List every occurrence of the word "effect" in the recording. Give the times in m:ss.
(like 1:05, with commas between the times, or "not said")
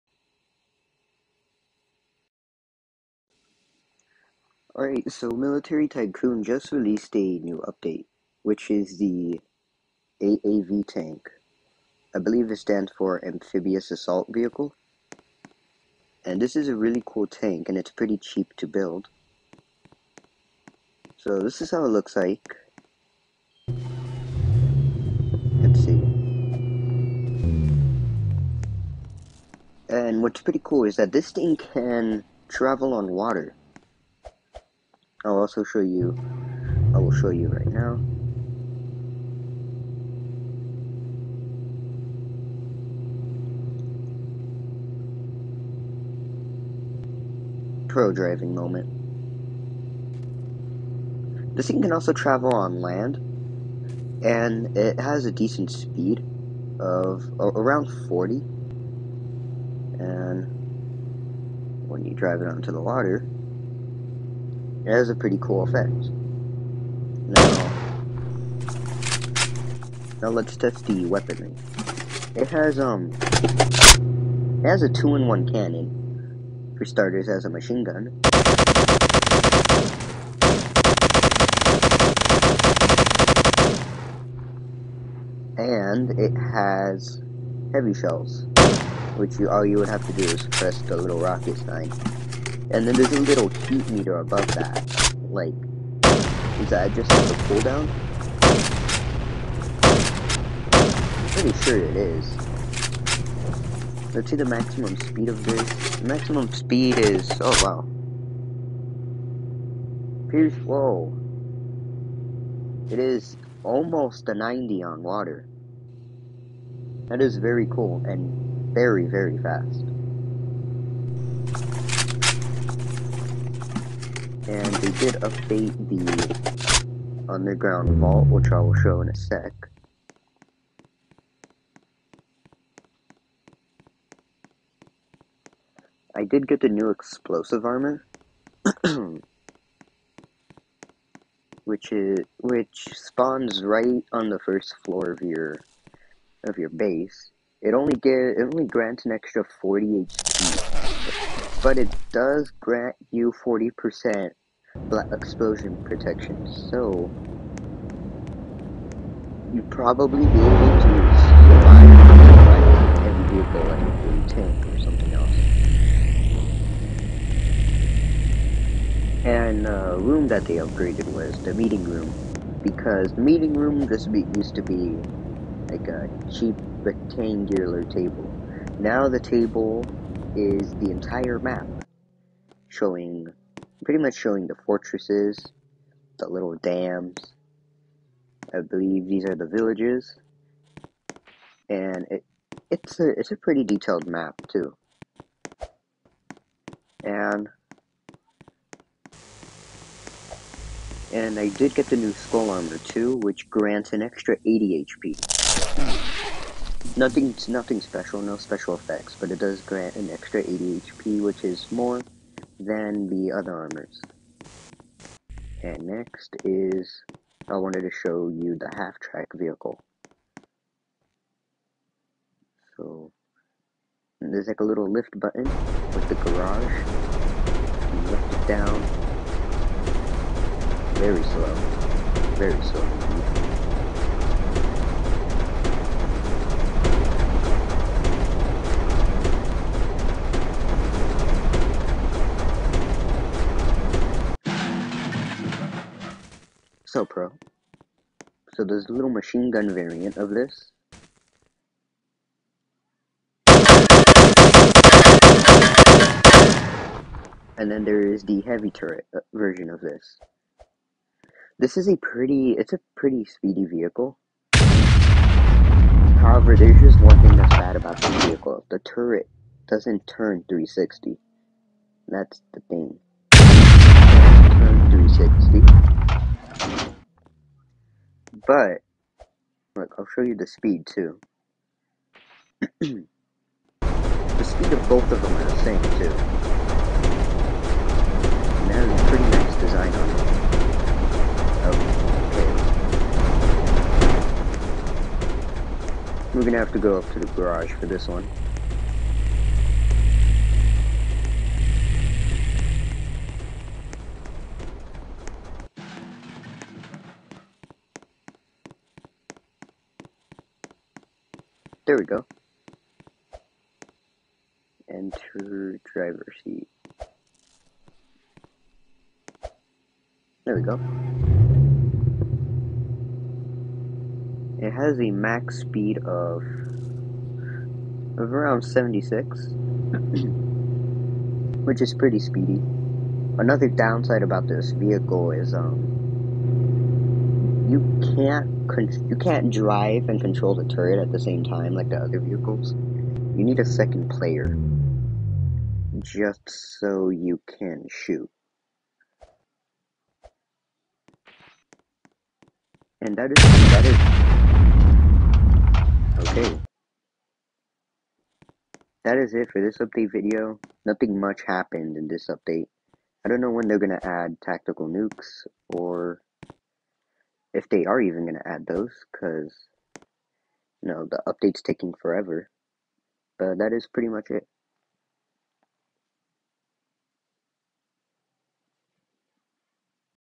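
1:05, 3:28.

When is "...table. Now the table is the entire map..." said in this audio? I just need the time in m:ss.
2:57.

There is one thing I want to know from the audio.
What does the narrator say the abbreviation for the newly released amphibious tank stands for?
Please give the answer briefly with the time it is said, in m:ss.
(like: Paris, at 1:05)
Amphibious Assault Vehicle, at 0:13.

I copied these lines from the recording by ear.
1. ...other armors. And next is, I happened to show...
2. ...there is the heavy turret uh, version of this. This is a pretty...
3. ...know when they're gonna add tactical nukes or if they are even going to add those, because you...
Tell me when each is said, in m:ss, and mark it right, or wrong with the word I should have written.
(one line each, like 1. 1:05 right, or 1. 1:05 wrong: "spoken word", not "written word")
1. 3:33 wrong: "wanted", not "happened"
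2. 4:17 right
3. 6:03 right.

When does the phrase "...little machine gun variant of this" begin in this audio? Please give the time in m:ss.
4:08.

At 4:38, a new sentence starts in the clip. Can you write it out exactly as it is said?
But, look, I'll show you the speed too.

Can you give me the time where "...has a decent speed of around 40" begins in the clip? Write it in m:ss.
0:54.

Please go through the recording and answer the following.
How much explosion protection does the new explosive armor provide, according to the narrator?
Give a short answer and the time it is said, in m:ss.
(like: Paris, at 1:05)
40%, at 2:33.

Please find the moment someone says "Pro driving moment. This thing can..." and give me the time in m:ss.
0:47.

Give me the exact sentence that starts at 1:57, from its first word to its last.
That is very cool and very, very fast and they did update the underground vault, which I will show in a sec.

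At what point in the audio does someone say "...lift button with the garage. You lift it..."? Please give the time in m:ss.
3:44.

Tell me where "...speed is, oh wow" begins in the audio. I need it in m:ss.
1:46.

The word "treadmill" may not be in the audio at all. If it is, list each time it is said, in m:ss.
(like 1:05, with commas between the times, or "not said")
not said.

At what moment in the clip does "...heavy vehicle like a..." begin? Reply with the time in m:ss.
2:43.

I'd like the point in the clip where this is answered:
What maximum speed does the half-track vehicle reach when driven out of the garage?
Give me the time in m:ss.
5:28.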